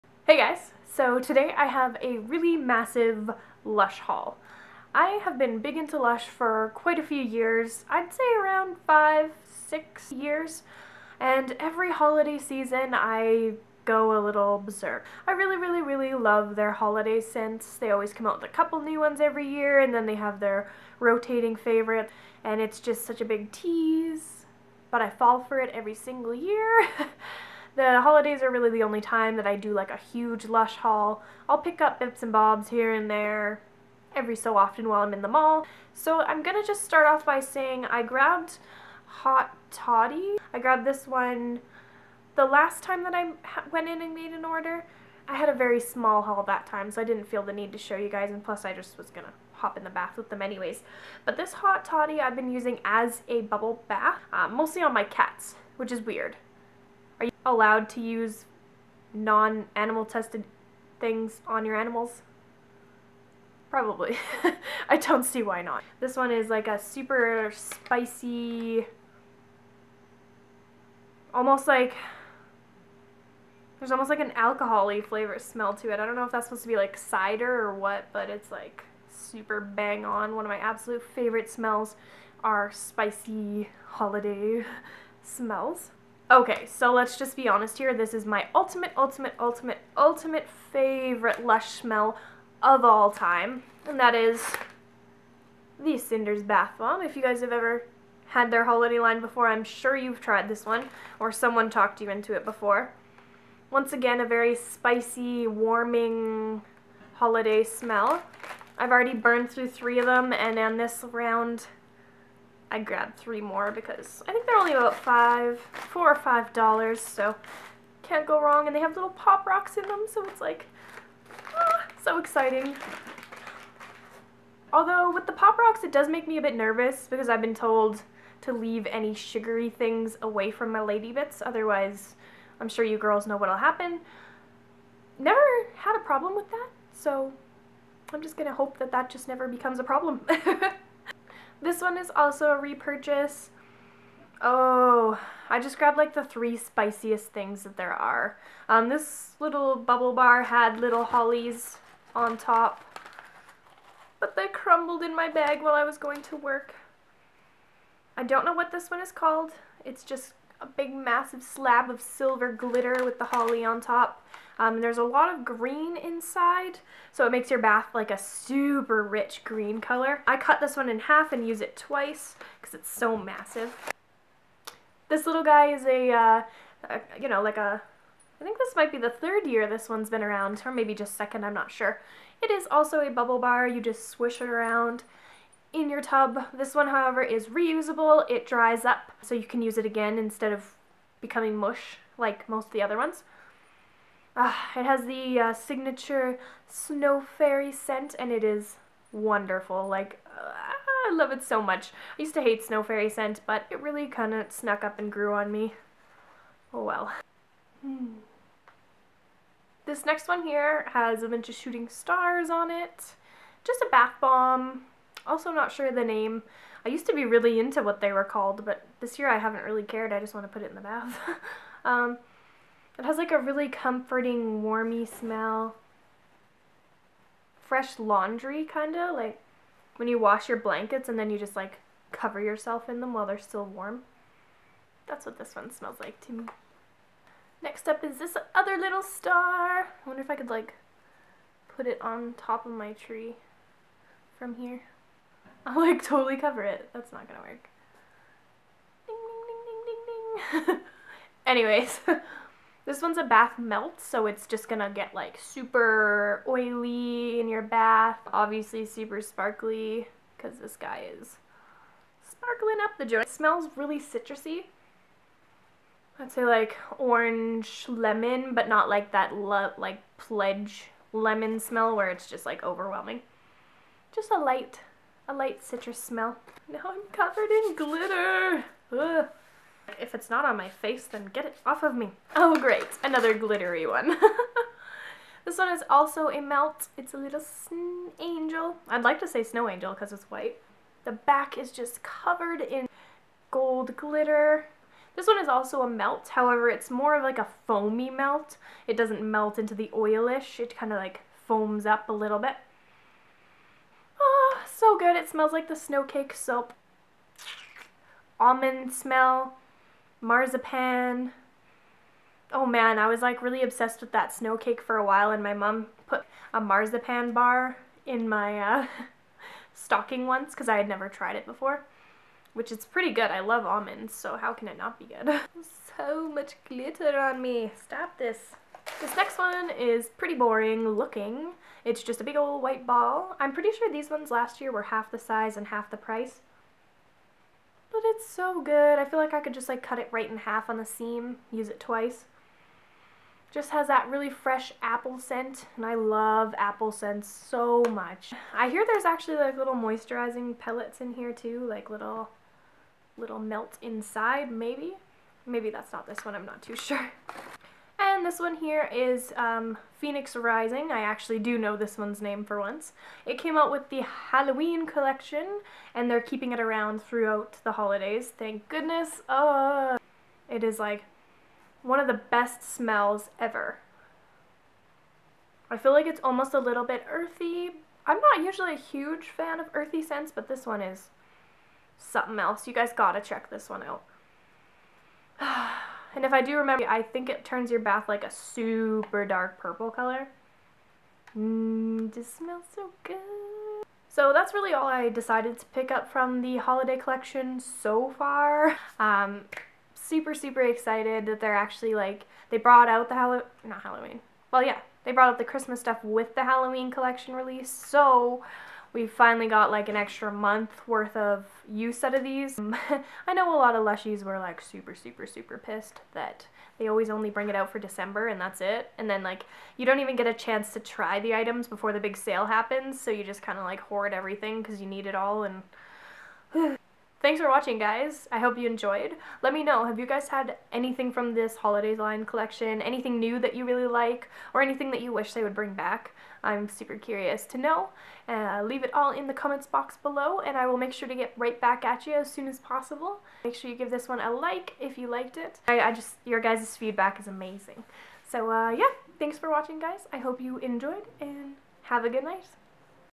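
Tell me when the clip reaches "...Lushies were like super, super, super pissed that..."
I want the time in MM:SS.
06:53.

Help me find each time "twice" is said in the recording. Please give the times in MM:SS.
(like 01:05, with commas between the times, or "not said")
02:51, 05:41.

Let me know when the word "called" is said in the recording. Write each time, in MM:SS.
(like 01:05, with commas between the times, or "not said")
02:39, 03:38.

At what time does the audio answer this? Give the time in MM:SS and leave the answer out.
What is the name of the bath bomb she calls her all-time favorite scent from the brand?
01:35.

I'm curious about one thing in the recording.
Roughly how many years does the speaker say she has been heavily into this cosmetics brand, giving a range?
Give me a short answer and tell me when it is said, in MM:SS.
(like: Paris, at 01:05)
5 or 6 years, at 00:08.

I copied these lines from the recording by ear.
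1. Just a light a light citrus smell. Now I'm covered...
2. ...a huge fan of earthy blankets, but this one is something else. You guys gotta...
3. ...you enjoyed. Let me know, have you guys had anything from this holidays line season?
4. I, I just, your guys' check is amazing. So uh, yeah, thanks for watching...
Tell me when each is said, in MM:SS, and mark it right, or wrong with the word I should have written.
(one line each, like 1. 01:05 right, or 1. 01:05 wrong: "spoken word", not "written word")
1. 04:34 right
2. 06:18 wrong: "scents", not "blankets"
3. 07:08 wrong: "collection", not "season"
4. 07:25 wrong: "feedback", not "check".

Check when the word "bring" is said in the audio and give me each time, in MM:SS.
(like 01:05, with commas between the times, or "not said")
06:57, 07:15.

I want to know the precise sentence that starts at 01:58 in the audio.
And they have little pop rocks in them, so it's like, ah, so exciting.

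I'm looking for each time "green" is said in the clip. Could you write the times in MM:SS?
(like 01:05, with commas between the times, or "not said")
02:45, 02:49.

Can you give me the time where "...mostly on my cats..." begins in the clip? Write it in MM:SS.
00:54.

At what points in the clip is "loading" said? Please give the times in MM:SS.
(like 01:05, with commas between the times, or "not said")
not said.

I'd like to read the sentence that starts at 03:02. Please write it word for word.
It is also a bubble bar, you just swish it around in your tub.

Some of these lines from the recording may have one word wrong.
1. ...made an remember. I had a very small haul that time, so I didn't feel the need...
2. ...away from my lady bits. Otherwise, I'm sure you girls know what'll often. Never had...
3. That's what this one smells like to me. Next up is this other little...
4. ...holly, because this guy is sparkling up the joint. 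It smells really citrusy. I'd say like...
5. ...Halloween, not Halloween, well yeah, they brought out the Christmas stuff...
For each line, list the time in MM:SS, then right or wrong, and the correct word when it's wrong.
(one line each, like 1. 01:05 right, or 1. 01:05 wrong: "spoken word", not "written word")
1. 00:44 wrong: "order", not "remember"
2. 02:10 wrong: "happen", not "often"
3. 03:55 right
4. 04:19 wrong: "sparkly", not "holly"
5. 06:43 right.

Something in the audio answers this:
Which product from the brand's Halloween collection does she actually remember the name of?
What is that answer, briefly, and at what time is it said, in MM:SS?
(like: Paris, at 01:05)
Phoenix Rising, at 05:59.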